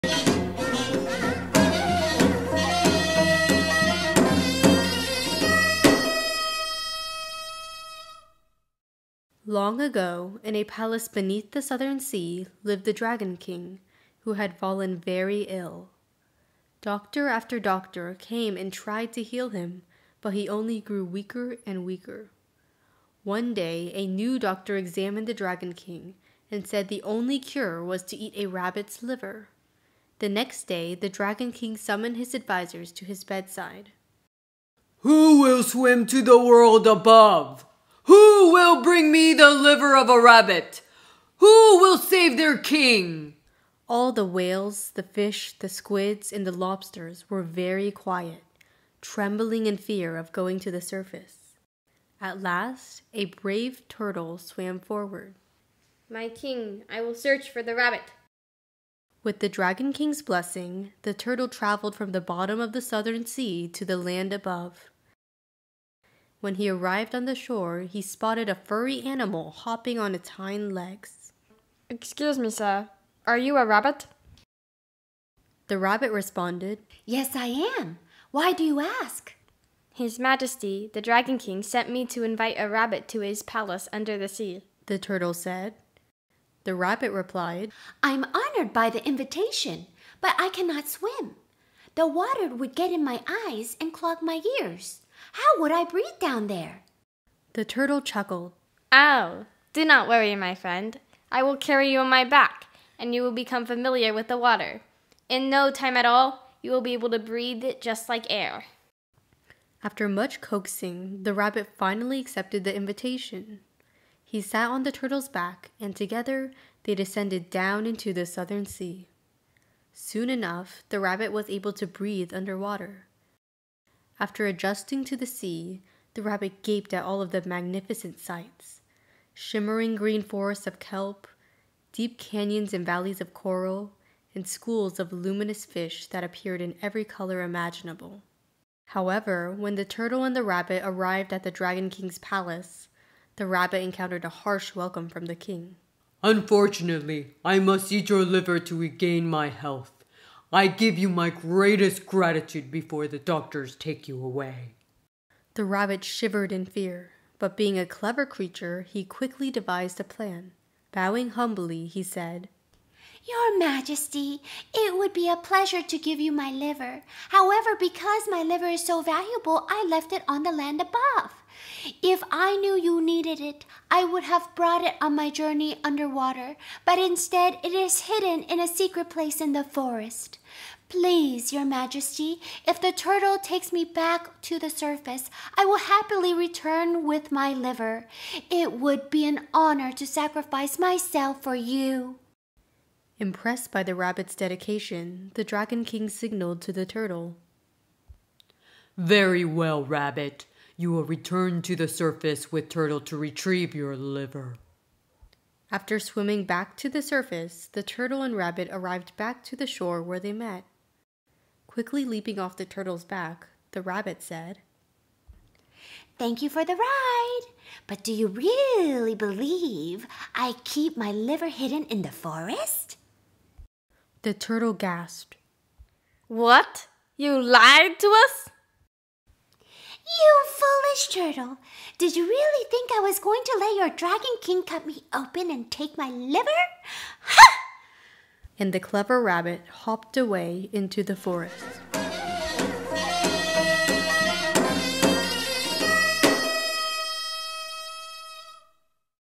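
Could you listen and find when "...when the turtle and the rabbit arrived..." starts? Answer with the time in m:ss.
2:19.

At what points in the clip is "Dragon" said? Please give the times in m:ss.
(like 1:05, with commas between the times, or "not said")
0:12, 0:25, 0:31, 0:59, 1:21, 2:21, 3:15, 3:53.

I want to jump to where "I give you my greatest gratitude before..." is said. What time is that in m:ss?
2:30.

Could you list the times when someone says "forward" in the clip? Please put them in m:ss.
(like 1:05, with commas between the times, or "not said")
0:54.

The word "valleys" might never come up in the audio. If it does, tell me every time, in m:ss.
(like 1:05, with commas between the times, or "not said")
2:12.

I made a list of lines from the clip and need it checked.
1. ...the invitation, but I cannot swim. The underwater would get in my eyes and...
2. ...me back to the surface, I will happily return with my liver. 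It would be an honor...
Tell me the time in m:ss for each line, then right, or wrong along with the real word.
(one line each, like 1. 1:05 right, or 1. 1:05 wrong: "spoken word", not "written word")
1. 1:28 wrong: "water", not "underwater"
2. 3:03 right.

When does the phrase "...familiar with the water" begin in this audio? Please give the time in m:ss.
1:43.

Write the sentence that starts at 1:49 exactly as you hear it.
After much coaxing, the rabbit finally accepted the invitation.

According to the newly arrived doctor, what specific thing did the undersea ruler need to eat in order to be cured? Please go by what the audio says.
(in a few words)
rabbit's liver.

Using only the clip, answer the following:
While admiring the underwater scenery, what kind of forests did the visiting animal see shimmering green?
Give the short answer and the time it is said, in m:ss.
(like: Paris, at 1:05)
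kelp, at 2:10.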